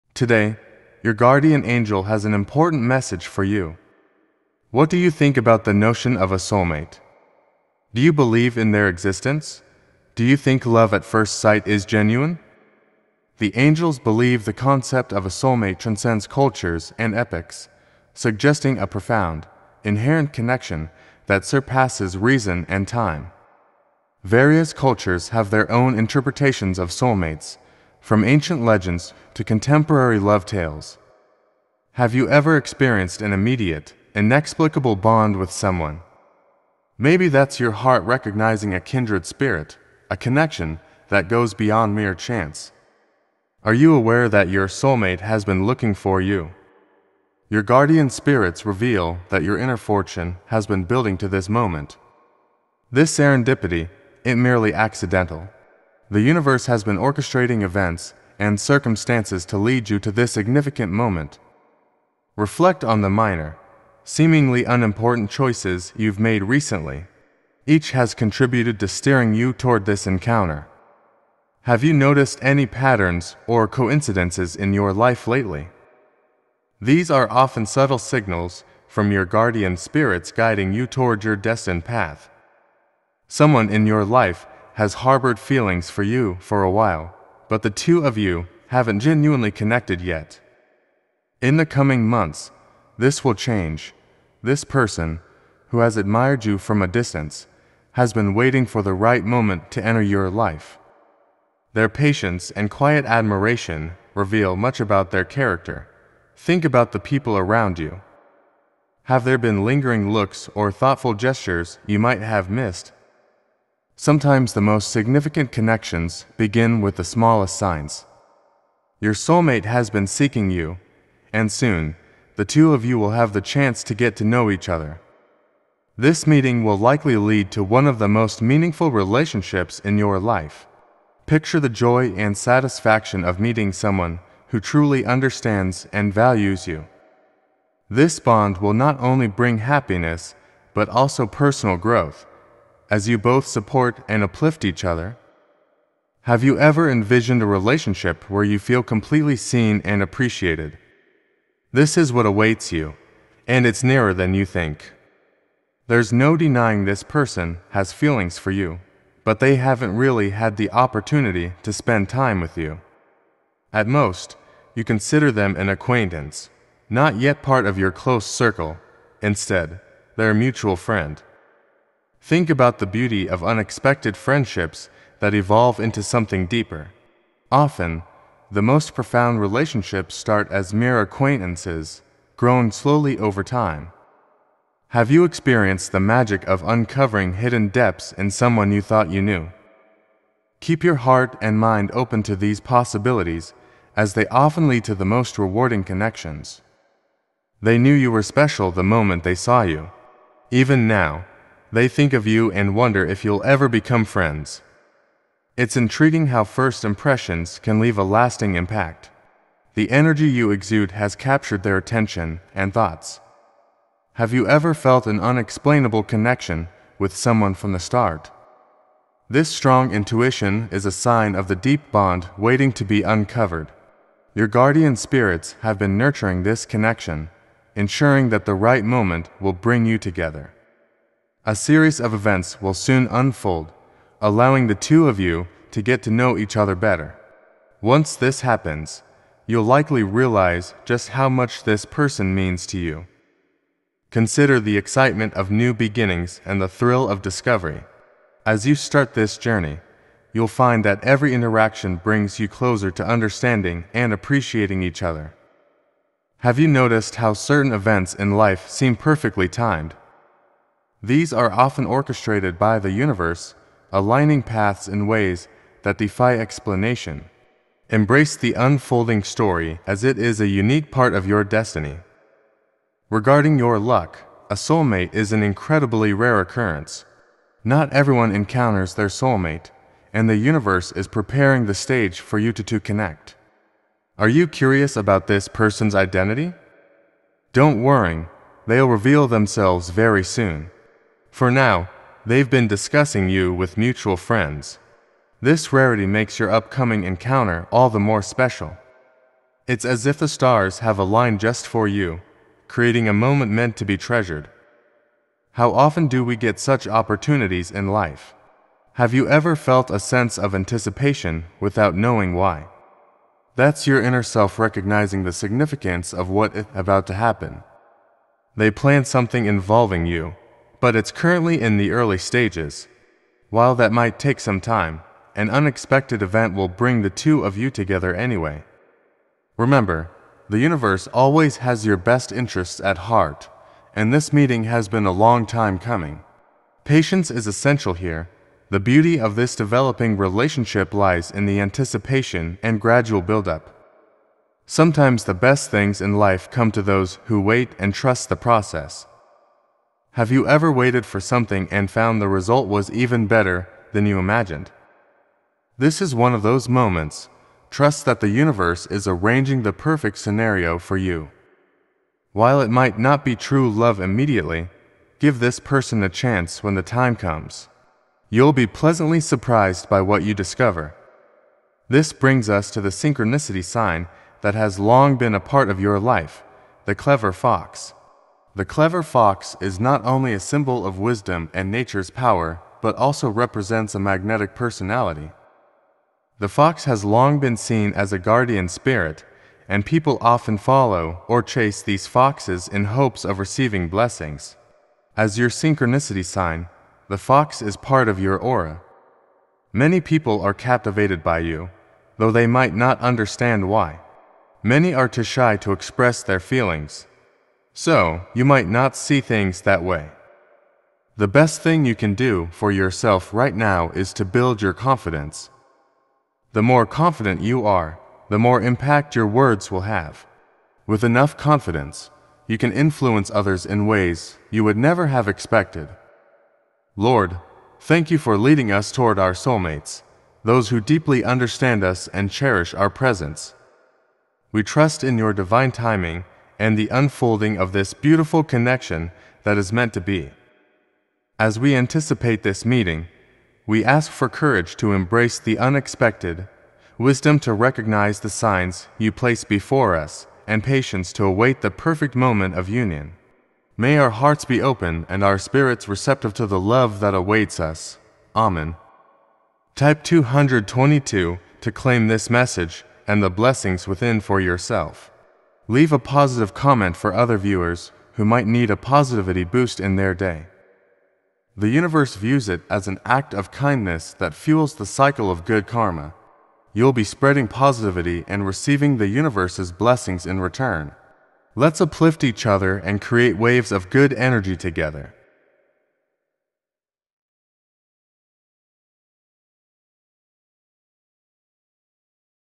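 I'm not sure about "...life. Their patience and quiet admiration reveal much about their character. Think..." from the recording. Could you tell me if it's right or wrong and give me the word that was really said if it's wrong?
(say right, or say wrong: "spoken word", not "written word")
right.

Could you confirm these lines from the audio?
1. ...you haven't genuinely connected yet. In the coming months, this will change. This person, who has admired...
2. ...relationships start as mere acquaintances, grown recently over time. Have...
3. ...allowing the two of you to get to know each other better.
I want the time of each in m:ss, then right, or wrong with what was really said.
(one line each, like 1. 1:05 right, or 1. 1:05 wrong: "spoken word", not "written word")
1. 1:28 right
2. 2:59 wrong: "slowly", not "recently"
3. 3:54 right.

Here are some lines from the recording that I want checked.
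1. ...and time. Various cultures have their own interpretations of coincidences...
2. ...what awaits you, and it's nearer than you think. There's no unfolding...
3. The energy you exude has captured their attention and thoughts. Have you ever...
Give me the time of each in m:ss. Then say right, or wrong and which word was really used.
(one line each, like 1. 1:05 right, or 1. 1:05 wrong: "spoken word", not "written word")
1. 0:22 wrong: "soulmates", not "coincidences"
2. 2:32 wrong: "denying", not "unfolding"
3. 3:29 right.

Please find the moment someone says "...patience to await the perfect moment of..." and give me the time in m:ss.
7:30.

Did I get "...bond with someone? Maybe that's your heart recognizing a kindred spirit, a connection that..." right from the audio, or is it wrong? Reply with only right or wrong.
right.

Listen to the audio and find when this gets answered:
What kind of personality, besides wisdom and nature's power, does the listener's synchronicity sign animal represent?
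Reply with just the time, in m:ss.
6:23.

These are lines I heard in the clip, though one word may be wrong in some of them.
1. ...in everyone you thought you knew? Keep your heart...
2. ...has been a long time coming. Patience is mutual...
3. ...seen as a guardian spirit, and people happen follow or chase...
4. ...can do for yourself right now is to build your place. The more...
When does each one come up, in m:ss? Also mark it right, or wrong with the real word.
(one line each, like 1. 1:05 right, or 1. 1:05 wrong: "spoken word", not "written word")
1. 3:08 wrong: "someone", not "everyone"
2. 5:34 wrong: "essential", not "mutual"
3. 6:27 wrong: "often", not "happen"
4. 6:51 wrong: "confidence", not "place".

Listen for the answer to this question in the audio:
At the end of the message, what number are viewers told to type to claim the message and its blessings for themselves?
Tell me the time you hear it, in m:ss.
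7:40.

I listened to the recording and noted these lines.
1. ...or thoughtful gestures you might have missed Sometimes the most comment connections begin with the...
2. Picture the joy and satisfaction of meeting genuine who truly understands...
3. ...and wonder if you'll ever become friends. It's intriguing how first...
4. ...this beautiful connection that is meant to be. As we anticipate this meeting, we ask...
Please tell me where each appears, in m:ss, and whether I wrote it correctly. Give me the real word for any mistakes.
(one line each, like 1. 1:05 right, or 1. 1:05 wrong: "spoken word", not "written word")
1. 1:50 wrong: "significant", not "comment"
2. 2:11 wrong: "someone", not "genuine"
3. 3:22 right
4. 7:17 right.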